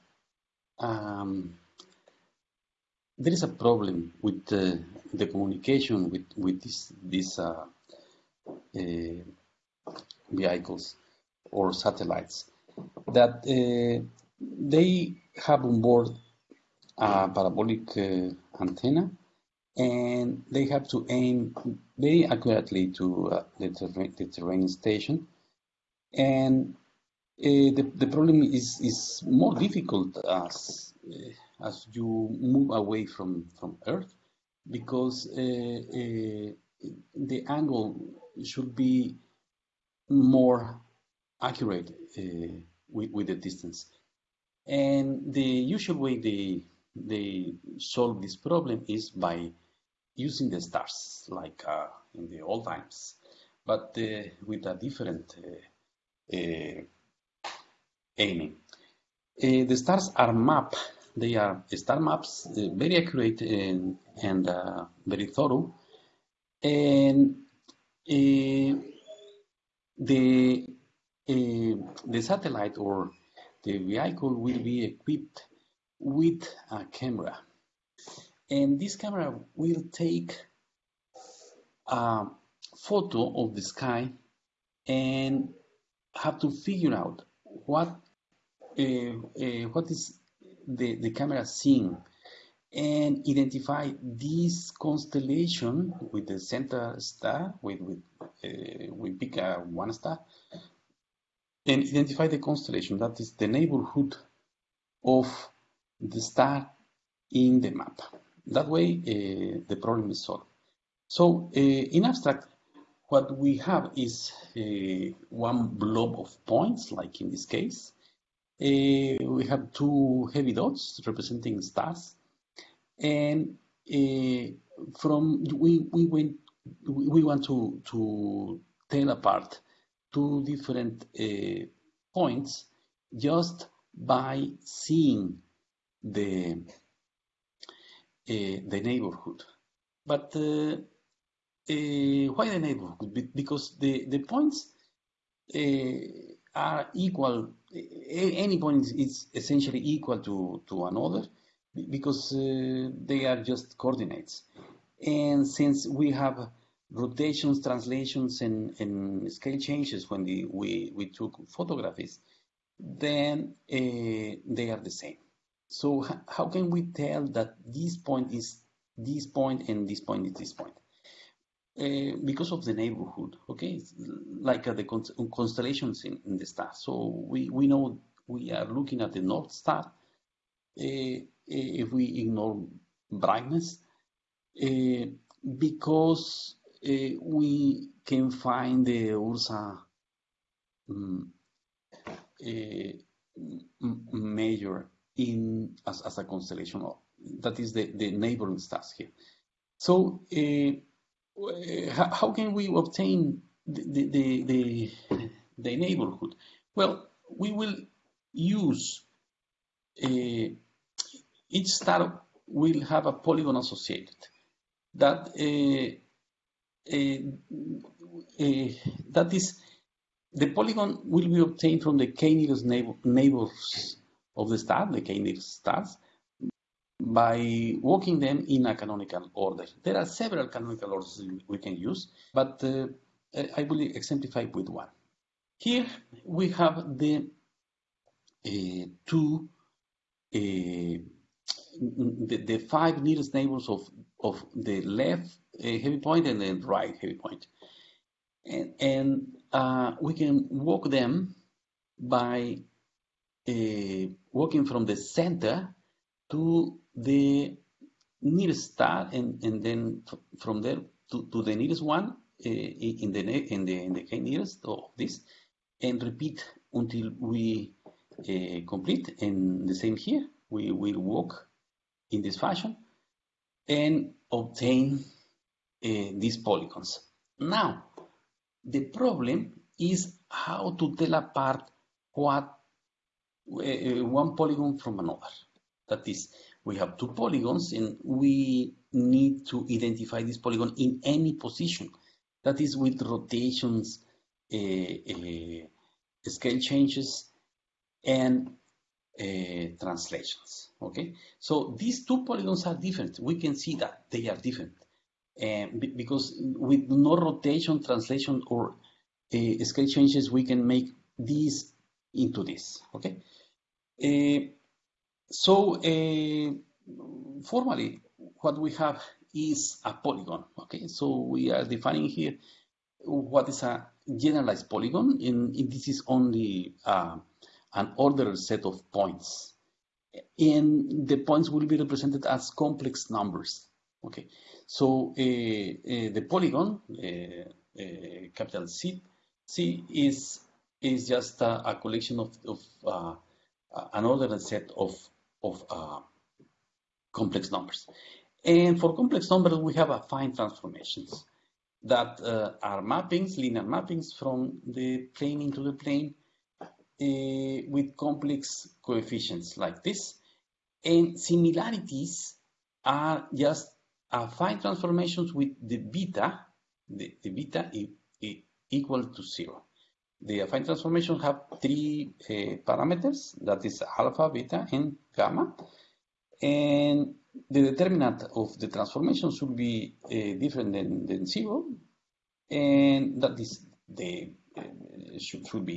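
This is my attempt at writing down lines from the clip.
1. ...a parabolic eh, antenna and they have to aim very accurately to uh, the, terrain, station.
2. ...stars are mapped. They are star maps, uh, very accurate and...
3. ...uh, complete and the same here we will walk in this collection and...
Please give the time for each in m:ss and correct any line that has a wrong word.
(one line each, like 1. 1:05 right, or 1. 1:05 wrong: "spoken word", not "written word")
1. 0:16 right
2. 0:59 right
3. 4:27 wrong: "fashion", not "collection".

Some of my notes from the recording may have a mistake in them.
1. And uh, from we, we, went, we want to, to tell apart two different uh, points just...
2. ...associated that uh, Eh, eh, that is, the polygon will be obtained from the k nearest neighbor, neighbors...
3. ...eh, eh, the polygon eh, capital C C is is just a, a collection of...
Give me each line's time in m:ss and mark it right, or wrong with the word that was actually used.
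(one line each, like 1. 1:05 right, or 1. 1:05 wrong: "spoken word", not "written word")
1. 2:02 right
2. 3:33 right
3. 5:35 right.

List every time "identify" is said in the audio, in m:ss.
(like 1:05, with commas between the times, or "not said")
1:33, 1:41, 4:49.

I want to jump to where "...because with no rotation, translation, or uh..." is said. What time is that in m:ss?
5:05.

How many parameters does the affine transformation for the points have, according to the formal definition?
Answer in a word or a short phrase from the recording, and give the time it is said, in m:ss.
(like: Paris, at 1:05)
3, at 6:11.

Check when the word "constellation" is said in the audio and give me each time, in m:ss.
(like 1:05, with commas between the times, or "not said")
1:34, 1:42, 2:55, 3:16.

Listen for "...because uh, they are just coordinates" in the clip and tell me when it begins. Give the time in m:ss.
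2:31.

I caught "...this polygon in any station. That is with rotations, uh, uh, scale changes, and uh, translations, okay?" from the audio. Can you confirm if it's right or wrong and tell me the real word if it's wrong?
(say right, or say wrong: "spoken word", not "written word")
wrong: "position", not "station".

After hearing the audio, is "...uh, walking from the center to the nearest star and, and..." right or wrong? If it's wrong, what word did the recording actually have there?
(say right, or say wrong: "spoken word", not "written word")
right.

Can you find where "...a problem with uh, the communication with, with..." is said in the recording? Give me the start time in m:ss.
0:03.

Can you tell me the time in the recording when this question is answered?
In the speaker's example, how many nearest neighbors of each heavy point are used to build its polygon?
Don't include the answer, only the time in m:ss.
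4:02.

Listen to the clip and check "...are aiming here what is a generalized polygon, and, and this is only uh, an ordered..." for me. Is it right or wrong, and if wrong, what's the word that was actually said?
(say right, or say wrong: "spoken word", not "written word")
wrong: "defining", not "aiming".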